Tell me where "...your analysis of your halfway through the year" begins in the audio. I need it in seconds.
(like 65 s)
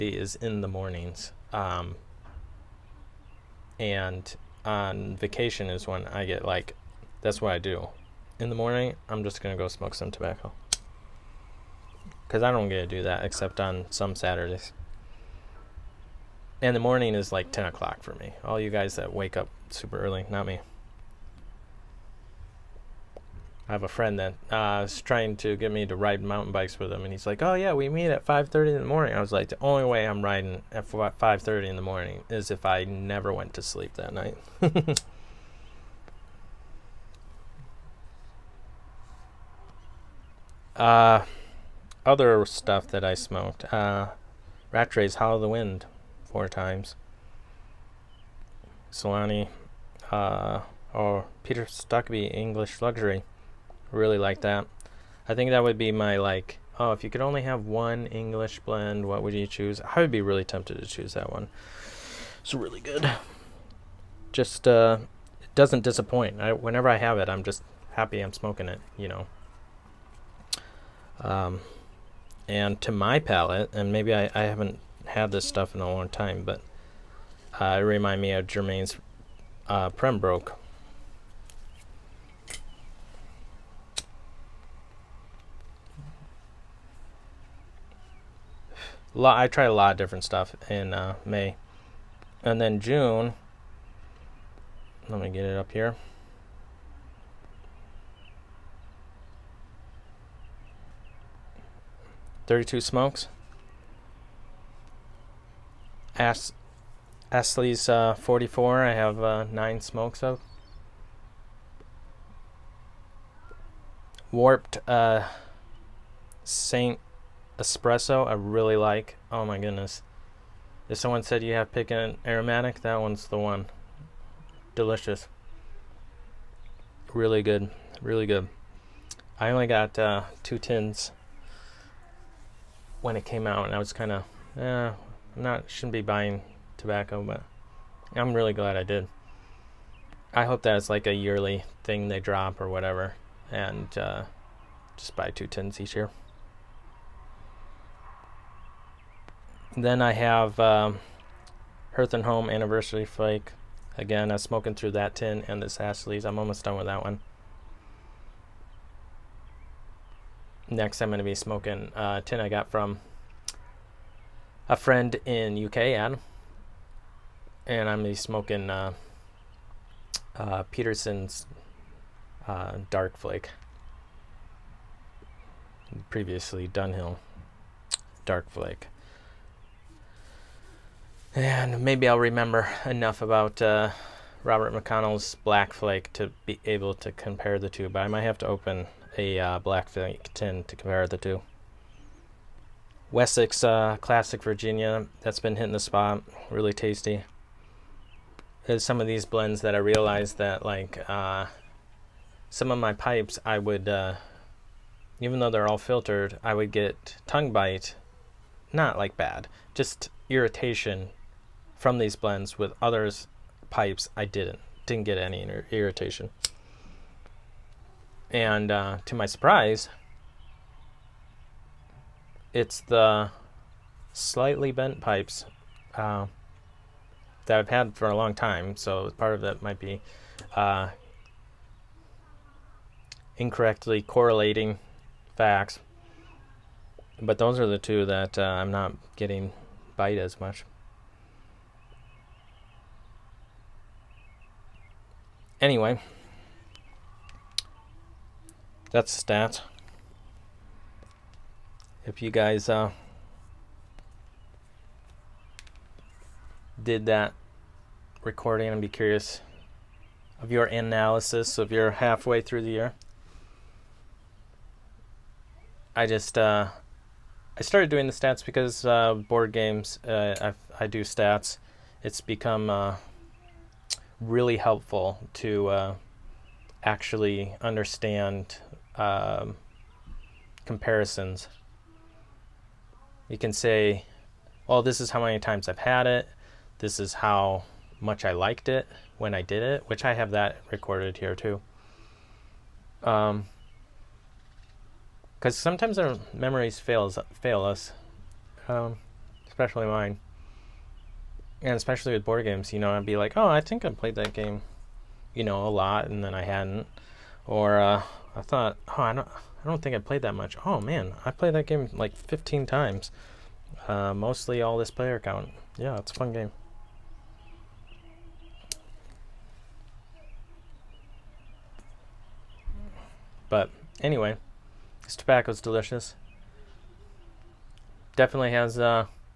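260 s.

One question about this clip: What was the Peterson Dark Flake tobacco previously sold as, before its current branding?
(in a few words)
Dunhill Dark Flake.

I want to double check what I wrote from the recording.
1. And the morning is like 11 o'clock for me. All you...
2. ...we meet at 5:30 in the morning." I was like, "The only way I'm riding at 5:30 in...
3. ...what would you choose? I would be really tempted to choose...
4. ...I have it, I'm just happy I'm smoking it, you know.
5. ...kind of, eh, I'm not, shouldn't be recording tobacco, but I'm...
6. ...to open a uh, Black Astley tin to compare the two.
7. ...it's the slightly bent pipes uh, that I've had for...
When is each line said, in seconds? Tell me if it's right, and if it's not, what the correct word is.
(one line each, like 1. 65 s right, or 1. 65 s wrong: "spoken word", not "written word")
1. 16 s wrong: "10", not "11"
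2. 27 s right
3. 59 s right
4. 66 s right
5. 133 s wrong: "buying", not "recording"
6. 188 s wrong: "Flake", not "Astley"
7. 222 s right.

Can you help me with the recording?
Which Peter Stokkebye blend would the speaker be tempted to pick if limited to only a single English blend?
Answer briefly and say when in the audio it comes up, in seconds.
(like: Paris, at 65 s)
English Luxury, at 52 s.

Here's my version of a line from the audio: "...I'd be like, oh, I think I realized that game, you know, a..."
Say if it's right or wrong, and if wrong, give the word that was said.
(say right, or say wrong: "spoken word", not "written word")
wrong: "played", not "realized".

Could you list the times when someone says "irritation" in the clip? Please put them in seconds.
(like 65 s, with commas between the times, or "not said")
210 s, 215 s.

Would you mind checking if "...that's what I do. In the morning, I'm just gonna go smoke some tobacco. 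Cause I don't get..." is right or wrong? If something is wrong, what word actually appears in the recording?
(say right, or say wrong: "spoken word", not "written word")
right.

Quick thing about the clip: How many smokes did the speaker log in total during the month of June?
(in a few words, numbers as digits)
32.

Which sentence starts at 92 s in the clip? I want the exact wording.
And then June, let me get it up here.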